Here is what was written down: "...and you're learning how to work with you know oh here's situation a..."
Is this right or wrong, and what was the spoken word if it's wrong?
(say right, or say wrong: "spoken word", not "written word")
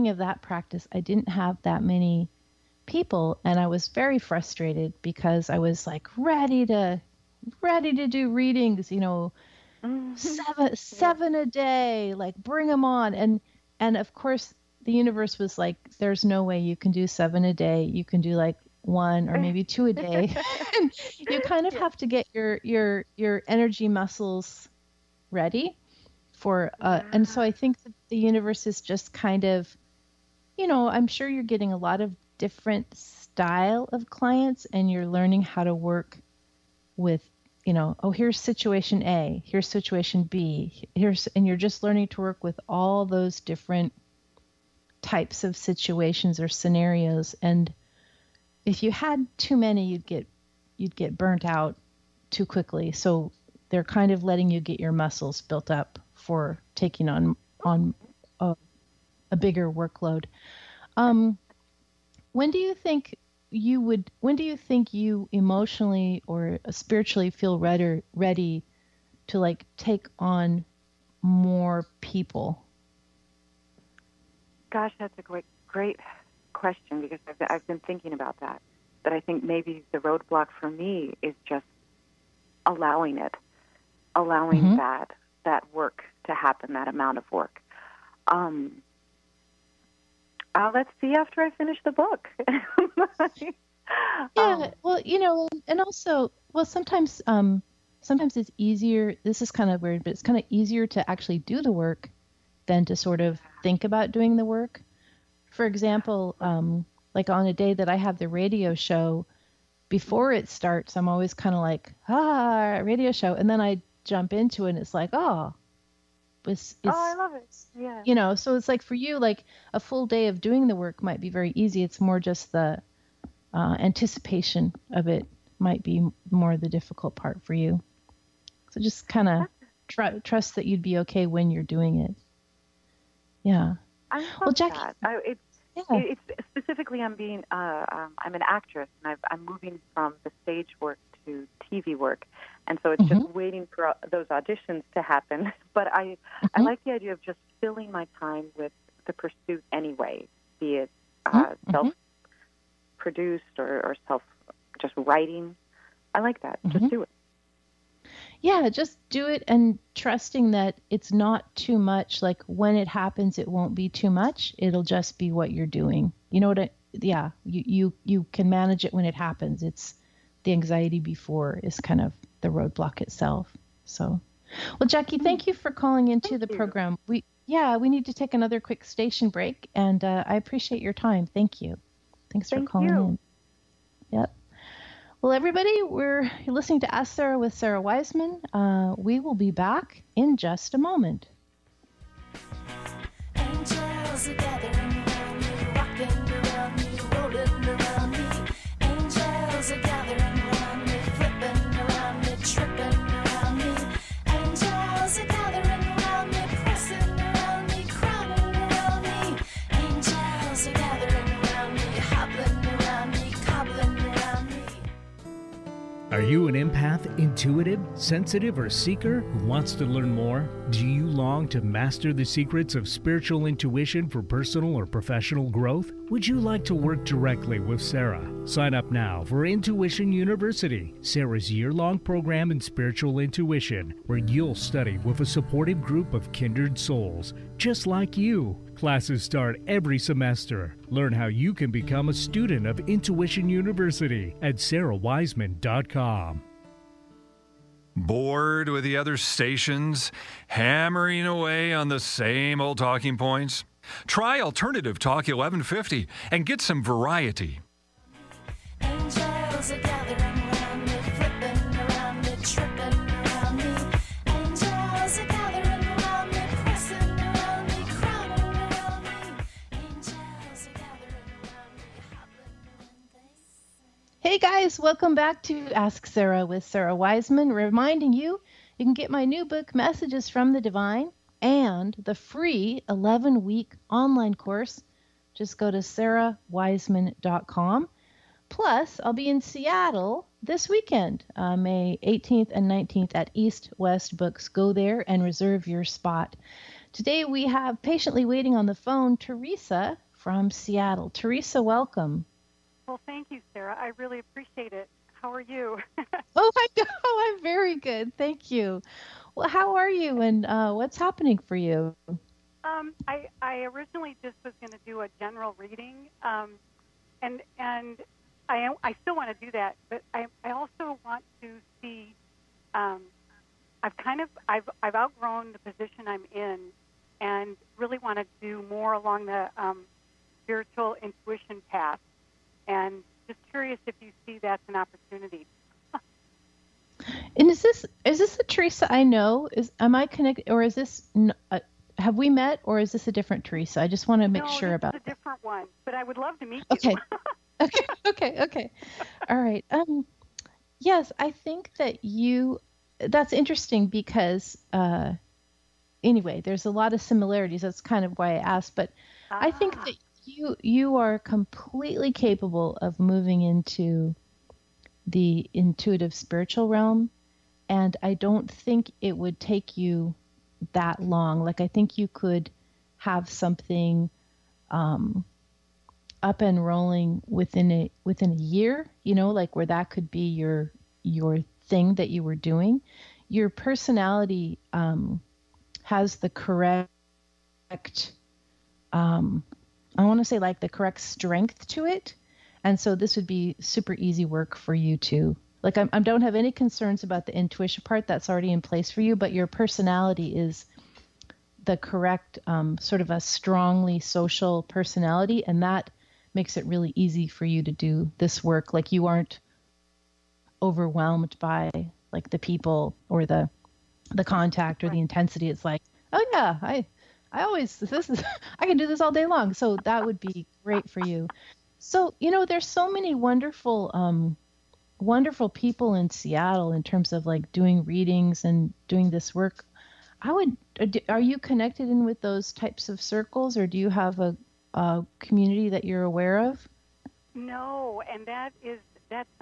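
right.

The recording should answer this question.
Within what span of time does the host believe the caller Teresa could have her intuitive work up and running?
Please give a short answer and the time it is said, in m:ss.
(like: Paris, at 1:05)
a year, at 6:18.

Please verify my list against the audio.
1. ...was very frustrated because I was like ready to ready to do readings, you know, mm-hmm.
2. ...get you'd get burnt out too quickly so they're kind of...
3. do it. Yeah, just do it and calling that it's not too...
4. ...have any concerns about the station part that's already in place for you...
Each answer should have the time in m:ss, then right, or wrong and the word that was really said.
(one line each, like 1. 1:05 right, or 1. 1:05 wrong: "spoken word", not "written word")
1. 0:03 right
2. 0:50 right
3. 2:36 wrong: "trusting", not "calling"
4. 6:36 wrong: "intuition", not "station".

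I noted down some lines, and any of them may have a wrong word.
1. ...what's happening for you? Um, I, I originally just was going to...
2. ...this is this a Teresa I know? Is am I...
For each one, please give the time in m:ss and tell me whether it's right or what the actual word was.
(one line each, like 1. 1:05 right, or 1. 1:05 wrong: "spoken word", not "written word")
1. 5:10 right
2. 5:37 right.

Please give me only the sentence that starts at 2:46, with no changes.
You know what I, yeah, you, you, you can manage it when it happens.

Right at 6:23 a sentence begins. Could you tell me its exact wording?
Your personality um, has the correct um, I want to say like the correct strength to it.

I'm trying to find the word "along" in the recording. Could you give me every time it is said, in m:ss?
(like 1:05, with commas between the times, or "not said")
5:28.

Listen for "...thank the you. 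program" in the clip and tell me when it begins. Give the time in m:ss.
2:56.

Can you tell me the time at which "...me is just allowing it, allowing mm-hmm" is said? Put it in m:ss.
1:20.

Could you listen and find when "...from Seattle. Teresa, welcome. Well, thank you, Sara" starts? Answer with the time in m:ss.
5:00.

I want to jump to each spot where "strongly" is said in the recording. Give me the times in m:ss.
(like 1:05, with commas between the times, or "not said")
6:43.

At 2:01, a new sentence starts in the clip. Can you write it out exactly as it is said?
It's more just the uh, anticipation of it might be more the difficult part for you.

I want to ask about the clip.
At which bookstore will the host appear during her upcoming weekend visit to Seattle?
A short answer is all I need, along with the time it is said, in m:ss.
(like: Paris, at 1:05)
East West Books, at 4:53.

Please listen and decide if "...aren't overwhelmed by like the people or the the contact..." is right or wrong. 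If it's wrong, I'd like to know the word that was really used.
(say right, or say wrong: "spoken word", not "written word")
right.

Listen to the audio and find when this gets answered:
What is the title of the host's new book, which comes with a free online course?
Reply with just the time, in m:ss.
4:39.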